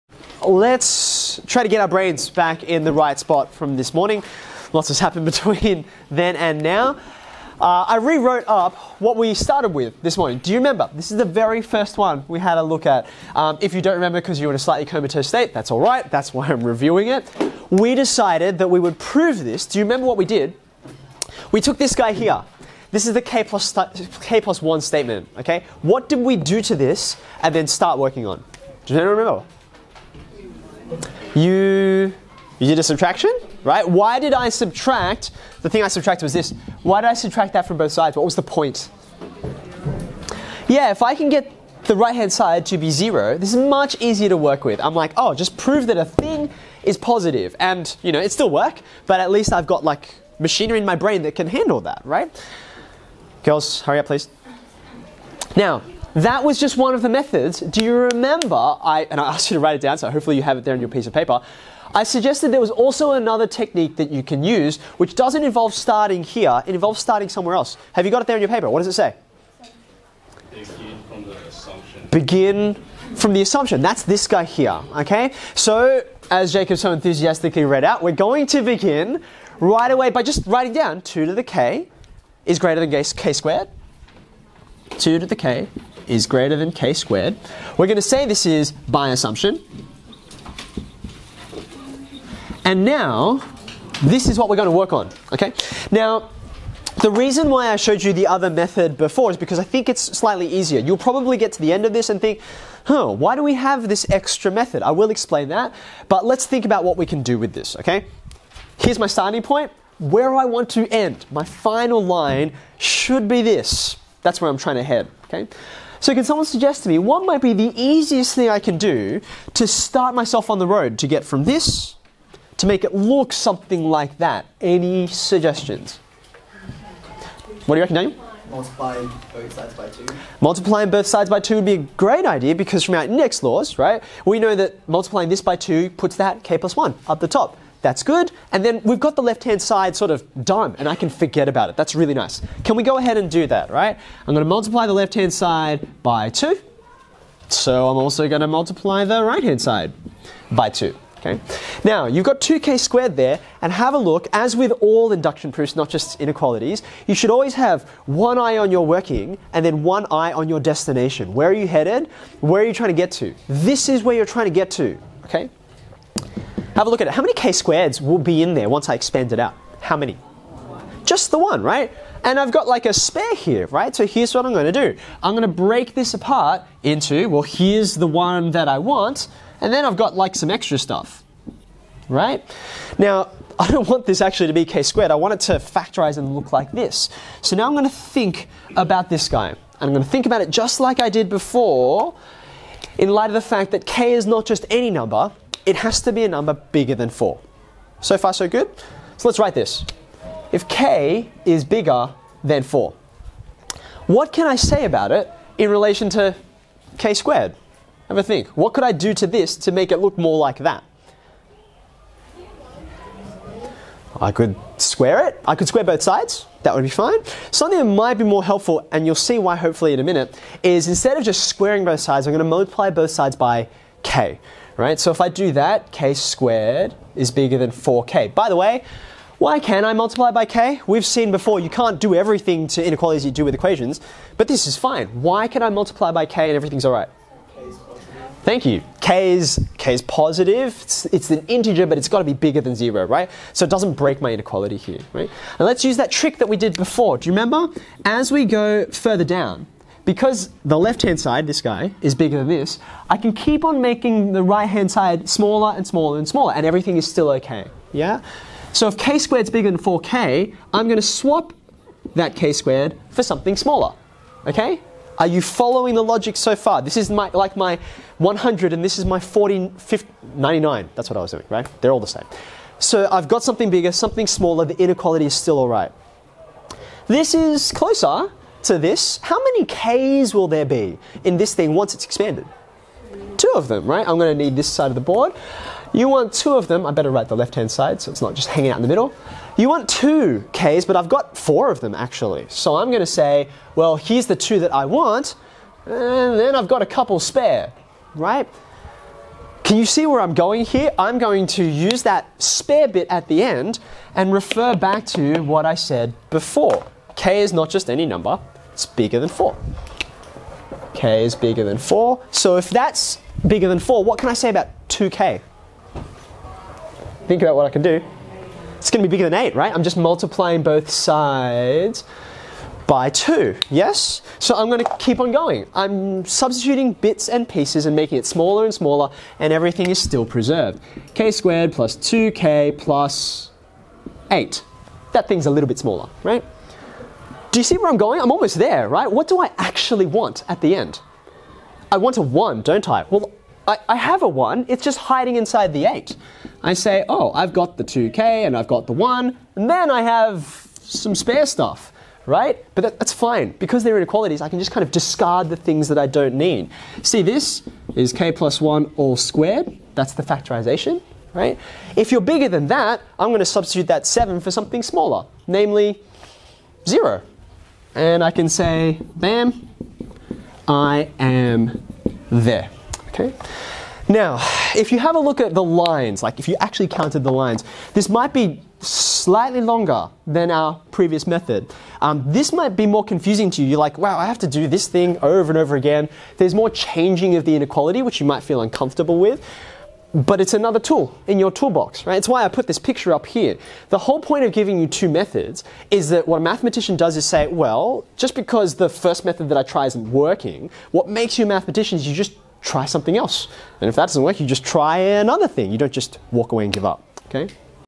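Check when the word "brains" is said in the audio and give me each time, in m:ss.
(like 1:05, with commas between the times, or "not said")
0:01, 0:50.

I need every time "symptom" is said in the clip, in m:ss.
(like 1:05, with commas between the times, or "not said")
not said.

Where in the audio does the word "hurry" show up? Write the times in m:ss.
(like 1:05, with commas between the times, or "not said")
0:53.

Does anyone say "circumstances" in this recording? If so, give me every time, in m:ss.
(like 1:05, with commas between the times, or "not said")
not said.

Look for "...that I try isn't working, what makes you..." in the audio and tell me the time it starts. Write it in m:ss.
6:39.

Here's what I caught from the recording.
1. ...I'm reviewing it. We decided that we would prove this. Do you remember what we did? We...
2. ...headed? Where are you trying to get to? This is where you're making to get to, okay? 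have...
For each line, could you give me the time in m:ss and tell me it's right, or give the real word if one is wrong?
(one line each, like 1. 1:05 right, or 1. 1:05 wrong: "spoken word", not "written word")
1. 0:16 right
2. 2:41 wrong: "trying", not "making".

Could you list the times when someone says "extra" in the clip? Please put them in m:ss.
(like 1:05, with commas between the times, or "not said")
1:44, 3:00.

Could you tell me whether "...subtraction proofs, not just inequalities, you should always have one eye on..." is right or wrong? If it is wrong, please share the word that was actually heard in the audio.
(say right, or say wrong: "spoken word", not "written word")
wrong: "induction", not "subtraction".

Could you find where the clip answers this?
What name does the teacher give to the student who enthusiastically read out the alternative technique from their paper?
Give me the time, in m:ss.
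1:16.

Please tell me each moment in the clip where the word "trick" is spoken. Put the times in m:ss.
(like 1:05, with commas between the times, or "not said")
4:06.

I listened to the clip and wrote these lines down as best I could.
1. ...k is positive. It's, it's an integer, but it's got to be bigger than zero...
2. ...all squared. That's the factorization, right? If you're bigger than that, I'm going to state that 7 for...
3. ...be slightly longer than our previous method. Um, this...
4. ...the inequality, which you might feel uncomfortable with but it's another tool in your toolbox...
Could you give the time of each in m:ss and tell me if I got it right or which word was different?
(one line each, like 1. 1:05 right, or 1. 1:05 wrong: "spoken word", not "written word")
1. 3:59 right
2. 5:58 wrong: "substitute", not "state"
3. 6:18 right
4. 6:27 right.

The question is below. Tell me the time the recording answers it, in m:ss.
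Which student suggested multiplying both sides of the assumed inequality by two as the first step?
2:07.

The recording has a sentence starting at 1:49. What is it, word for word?
Where I want to end, my final line should be this.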